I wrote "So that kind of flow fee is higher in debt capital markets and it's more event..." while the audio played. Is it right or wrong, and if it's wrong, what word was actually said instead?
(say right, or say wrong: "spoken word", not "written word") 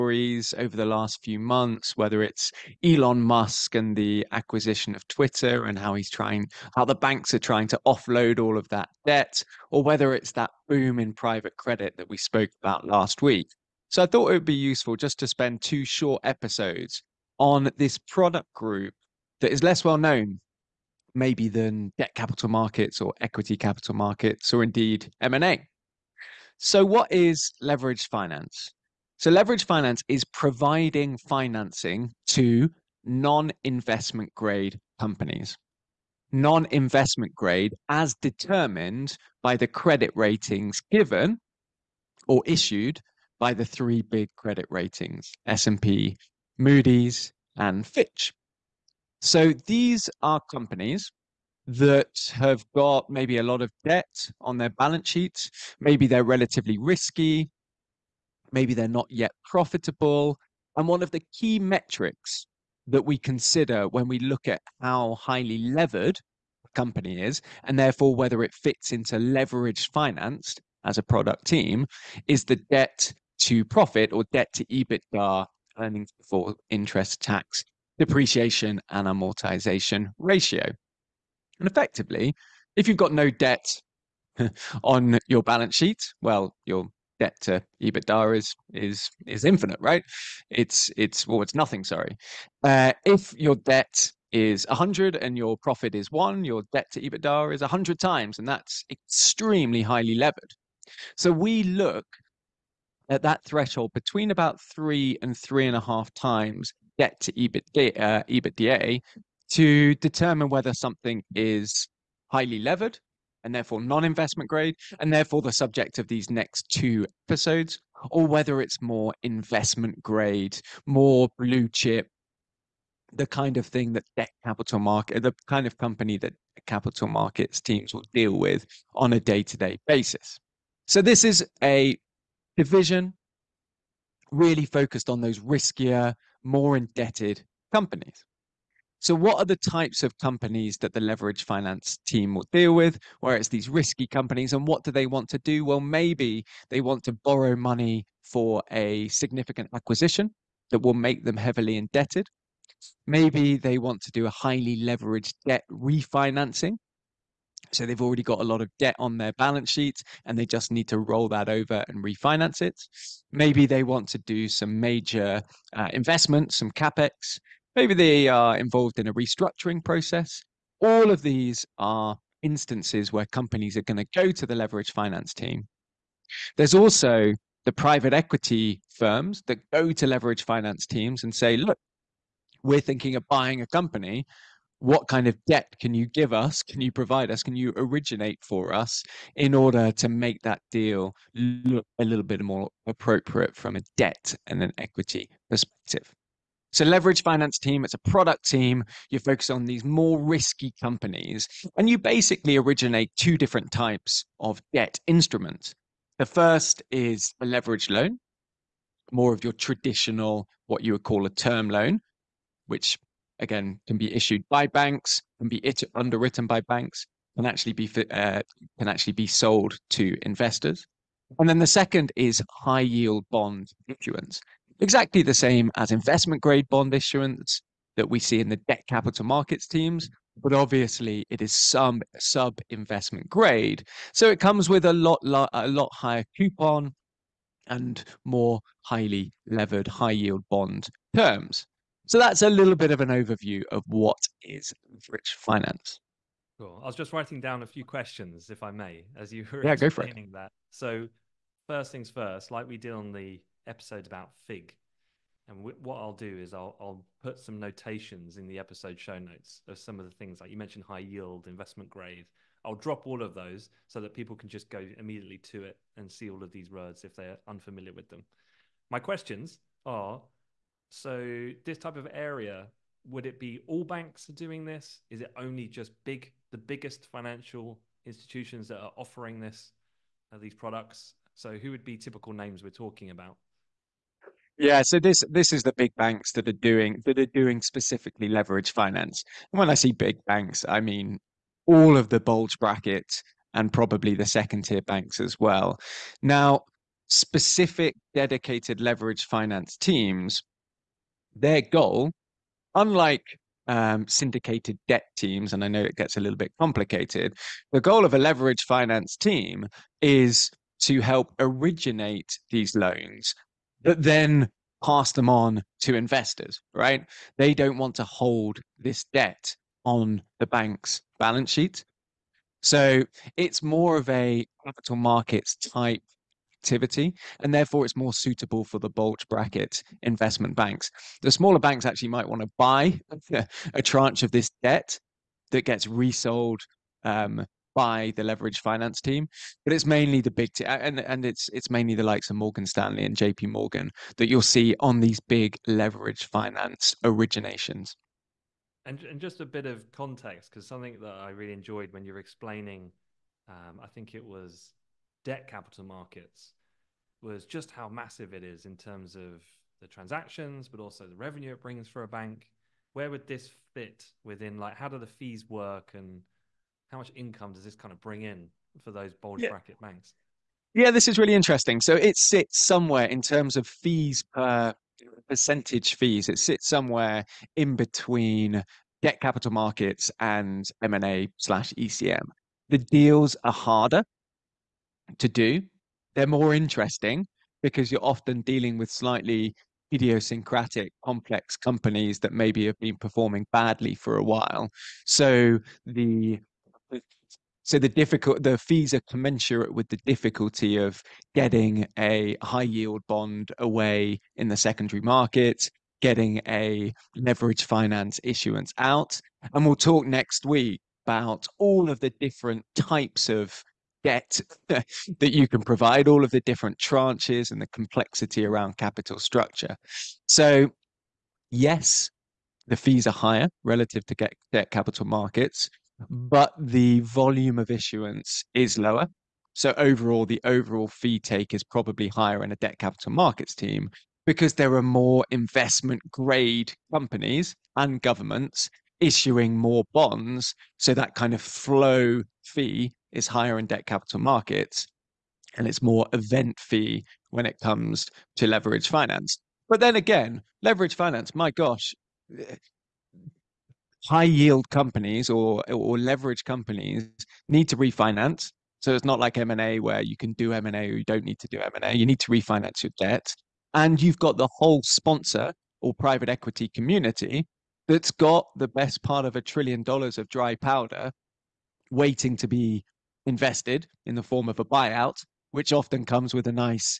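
right.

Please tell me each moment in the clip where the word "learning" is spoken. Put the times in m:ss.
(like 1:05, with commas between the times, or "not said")
not said.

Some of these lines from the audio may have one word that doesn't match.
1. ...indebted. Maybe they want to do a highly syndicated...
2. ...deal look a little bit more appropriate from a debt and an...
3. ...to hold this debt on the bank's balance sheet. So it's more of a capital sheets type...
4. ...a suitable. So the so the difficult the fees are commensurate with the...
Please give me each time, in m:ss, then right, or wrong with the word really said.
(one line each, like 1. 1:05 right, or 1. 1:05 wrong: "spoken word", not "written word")
1. 2:31 wrong: "leveraged", not "syndicated"
2. 3:10 right
3. 5:17 wrong: "markets", not "sheets"
4. 6:34 wrong: "while", not "suitable".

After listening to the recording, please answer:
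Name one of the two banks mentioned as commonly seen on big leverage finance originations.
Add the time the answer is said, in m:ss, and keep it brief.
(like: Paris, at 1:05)
Morgan Stanley, at 5:42.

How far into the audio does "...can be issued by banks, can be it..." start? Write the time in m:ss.
3:33.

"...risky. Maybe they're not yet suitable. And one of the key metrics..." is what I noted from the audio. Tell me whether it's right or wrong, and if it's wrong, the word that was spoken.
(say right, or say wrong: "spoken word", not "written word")
wrong: "profitable", not "suitable".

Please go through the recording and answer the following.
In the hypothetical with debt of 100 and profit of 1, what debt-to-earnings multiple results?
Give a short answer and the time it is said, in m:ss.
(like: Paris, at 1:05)
100 times, at 1:37.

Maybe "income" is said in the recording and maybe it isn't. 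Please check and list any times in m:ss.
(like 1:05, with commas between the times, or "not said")
6:07.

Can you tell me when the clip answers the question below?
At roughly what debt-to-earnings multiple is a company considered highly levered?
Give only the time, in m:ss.
1:44.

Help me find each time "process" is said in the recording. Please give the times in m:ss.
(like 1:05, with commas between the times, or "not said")
2:49.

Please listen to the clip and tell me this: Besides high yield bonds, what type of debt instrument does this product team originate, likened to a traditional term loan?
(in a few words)
Leverage loan.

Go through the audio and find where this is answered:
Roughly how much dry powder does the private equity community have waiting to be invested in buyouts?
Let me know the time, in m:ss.
7:49.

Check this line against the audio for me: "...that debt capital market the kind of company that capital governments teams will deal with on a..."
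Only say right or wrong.
wrong.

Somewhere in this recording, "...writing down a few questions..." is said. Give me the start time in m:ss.
4:07.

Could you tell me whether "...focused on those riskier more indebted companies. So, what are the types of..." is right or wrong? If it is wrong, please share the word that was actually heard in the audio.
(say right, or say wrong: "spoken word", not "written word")
right.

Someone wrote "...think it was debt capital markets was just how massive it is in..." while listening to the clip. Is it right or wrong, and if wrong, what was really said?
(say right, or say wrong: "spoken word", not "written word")
right.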